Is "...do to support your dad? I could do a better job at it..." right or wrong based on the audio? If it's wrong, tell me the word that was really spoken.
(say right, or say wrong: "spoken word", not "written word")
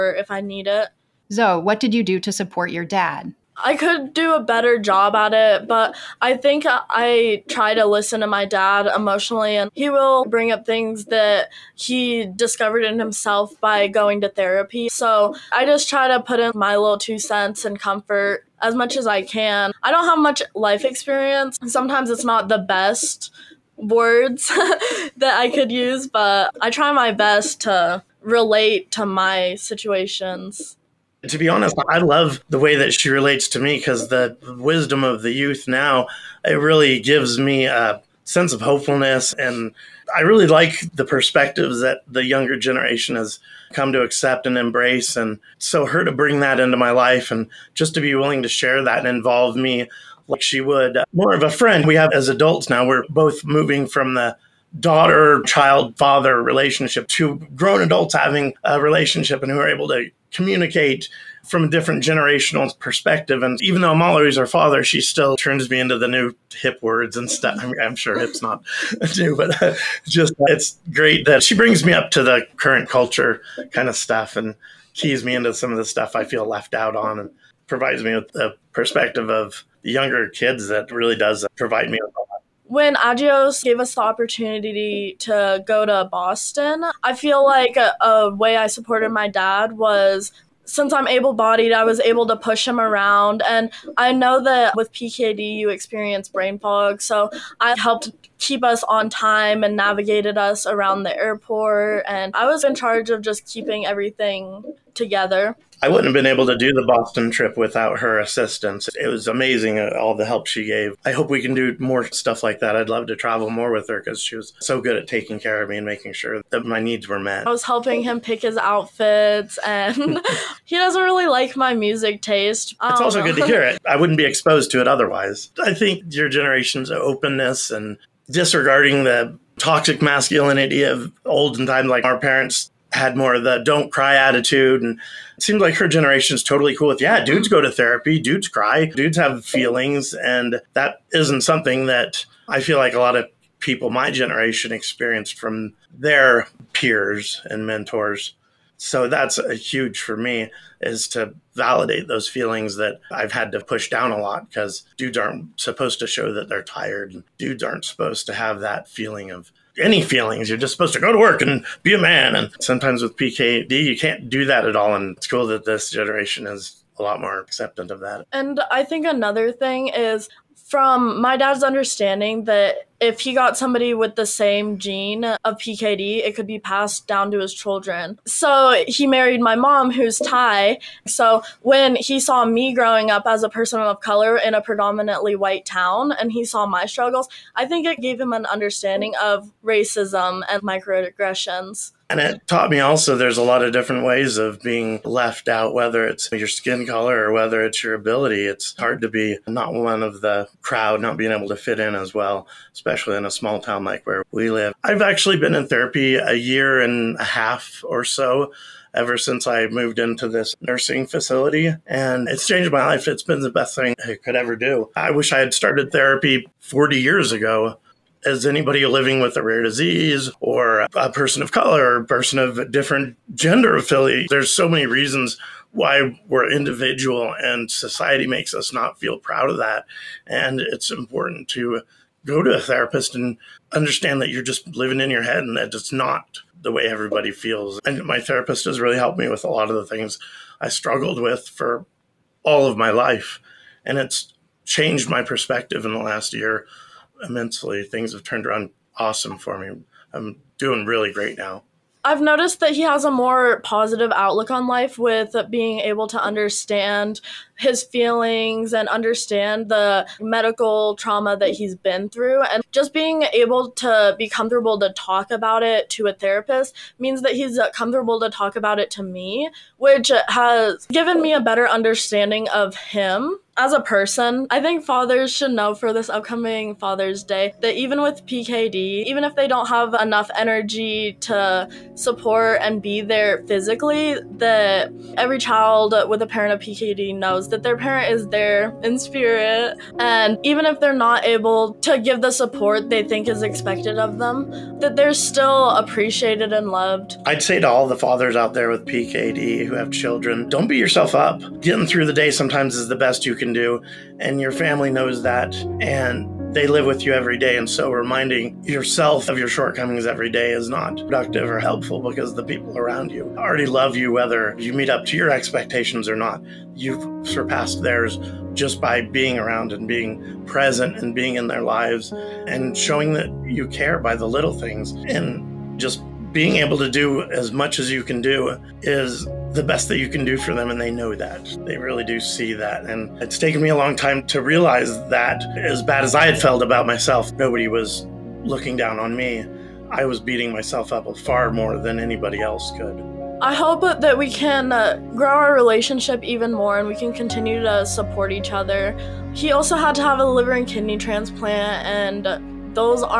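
right.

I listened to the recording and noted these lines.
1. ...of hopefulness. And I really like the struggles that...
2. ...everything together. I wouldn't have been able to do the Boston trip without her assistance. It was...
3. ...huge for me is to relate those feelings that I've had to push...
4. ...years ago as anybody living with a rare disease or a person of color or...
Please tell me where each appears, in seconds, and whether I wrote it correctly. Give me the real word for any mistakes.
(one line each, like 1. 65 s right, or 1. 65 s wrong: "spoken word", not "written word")
1. 38 s wrong: "perspectives", not "struggles"
2. 103 s right
3. 149 s wrong: "validate", not "relate"
4. 217 s right.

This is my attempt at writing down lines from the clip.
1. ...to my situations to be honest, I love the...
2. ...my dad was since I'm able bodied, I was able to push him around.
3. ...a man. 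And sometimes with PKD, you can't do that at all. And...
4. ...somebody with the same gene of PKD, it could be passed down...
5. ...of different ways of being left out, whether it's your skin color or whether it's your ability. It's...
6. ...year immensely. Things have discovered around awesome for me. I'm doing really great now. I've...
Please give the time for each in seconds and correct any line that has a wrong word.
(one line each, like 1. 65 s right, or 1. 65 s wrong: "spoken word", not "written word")
1. 28 s right
2. 89 s right
3. 161 s right
4. 173 s right
5. 193 s right
6. 246 s wrong: "turned", not "discovered".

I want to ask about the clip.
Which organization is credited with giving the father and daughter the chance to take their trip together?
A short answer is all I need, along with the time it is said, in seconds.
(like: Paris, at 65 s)
Agios, at 82 s.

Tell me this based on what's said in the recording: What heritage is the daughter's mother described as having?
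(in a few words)
Thai.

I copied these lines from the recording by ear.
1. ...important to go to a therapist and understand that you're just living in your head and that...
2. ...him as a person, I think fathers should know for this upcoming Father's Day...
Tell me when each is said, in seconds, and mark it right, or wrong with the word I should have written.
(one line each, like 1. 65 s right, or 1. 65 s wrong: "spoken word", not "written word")
1. 230 s right
2. 272 s right.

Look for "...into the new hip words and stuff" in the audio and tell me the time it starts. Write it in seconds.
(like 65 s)
65 s.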